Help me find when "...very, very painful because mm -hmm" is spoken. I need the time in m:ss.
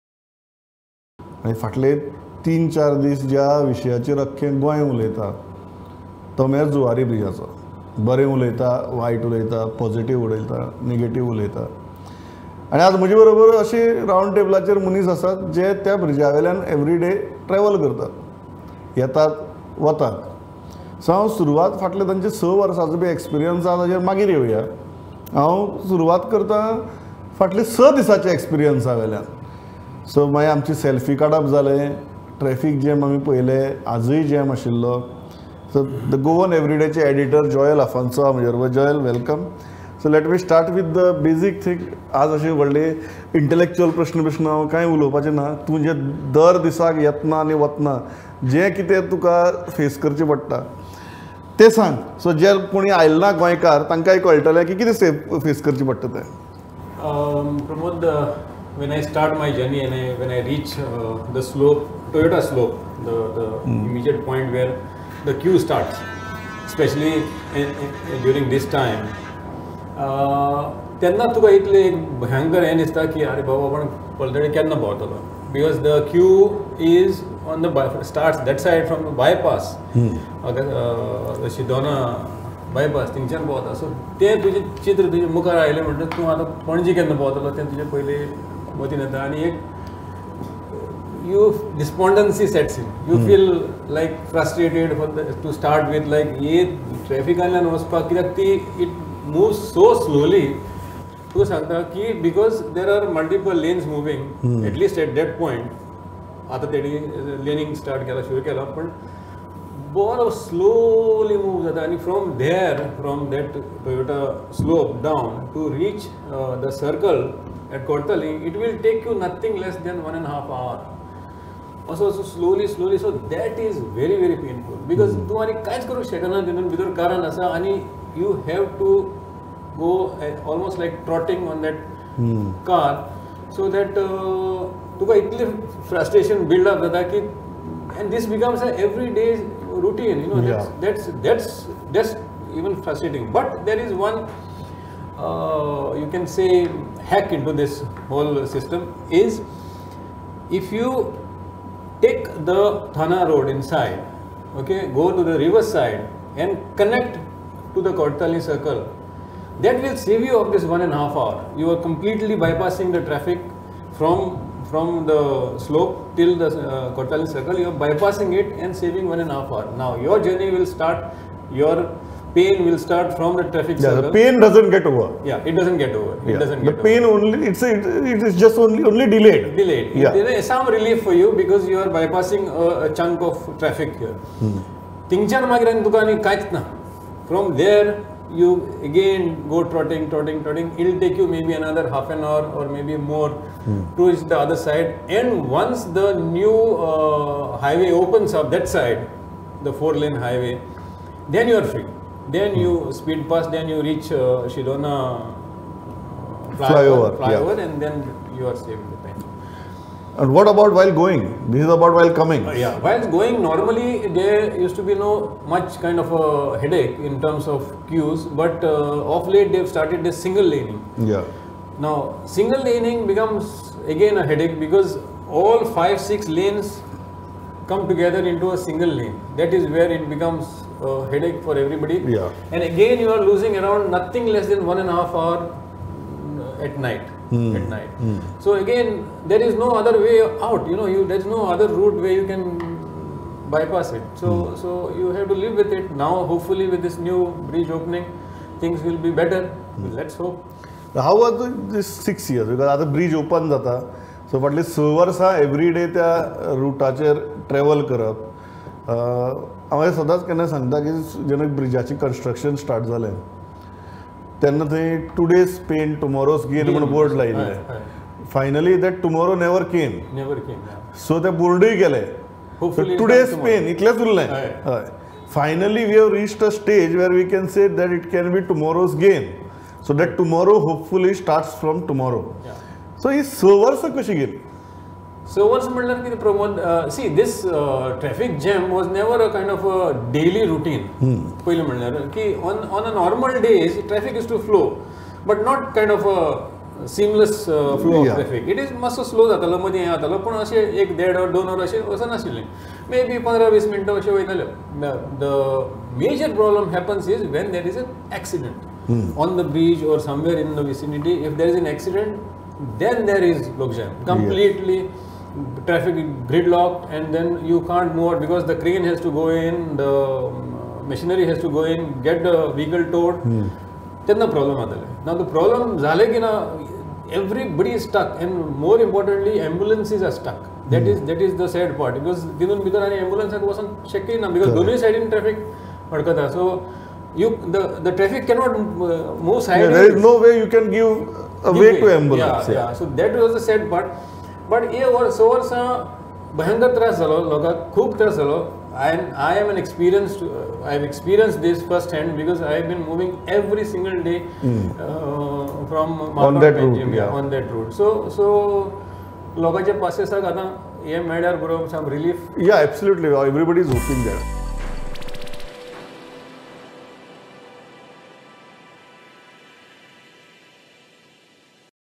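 2:03.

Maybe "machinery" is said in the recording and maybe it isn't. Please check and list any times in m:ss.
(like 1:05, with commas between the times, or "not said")
5:20.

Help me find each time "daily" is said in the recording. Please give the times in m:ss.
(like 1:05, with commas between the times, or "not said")
4:50.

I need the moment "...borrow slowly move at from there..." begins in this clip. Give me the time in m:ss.
1:49.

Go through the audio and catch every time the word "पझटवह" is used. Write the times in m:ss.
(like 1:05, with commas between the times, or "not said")
0:09.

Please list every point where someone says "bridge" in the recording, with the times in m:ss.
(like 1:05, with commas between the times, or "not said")
4:07, 5:09.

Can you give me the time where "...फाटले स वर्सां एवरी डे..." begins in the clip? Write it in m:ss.
4:14.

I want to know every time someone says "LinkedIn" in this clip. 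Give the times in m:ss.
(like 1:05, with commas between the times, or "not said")
not said.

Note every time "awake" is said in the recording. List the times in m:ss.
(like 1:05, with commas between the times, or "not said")
not said.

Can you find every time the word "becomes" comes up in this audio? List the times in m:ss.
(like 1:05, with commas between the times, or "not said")
2:18, 3:43, 3:50.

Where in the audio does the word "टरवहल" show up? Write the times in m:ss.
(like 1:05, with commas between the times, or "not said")
0:17, 4:17.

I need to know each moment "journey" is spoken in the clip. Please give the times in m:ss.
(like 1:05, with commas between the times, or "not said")
0:59, 2:50.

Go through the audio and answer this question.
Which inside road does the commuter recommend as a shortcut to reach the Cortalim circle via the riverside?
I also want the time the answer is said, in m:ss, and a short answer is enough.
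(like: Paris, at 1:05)
Thana road, at 2:32.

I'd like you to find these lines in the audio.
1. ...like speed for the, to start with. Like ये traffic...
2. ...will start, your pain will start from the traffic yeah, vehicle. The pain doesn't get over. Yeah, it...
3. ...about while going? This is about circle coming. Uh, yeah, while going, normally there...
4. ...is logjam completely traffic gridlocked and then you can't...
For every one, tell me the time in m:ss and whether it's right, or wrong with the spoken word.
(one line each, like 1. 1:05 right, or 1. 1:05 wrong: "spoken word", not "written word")
1. 1:33 wrong: "frustrated", not "speed"
2. 2:50 wrong: "circle", not "vehicle"
3. 3:30 wrong: "while", not "circle"
4. 5:13 right.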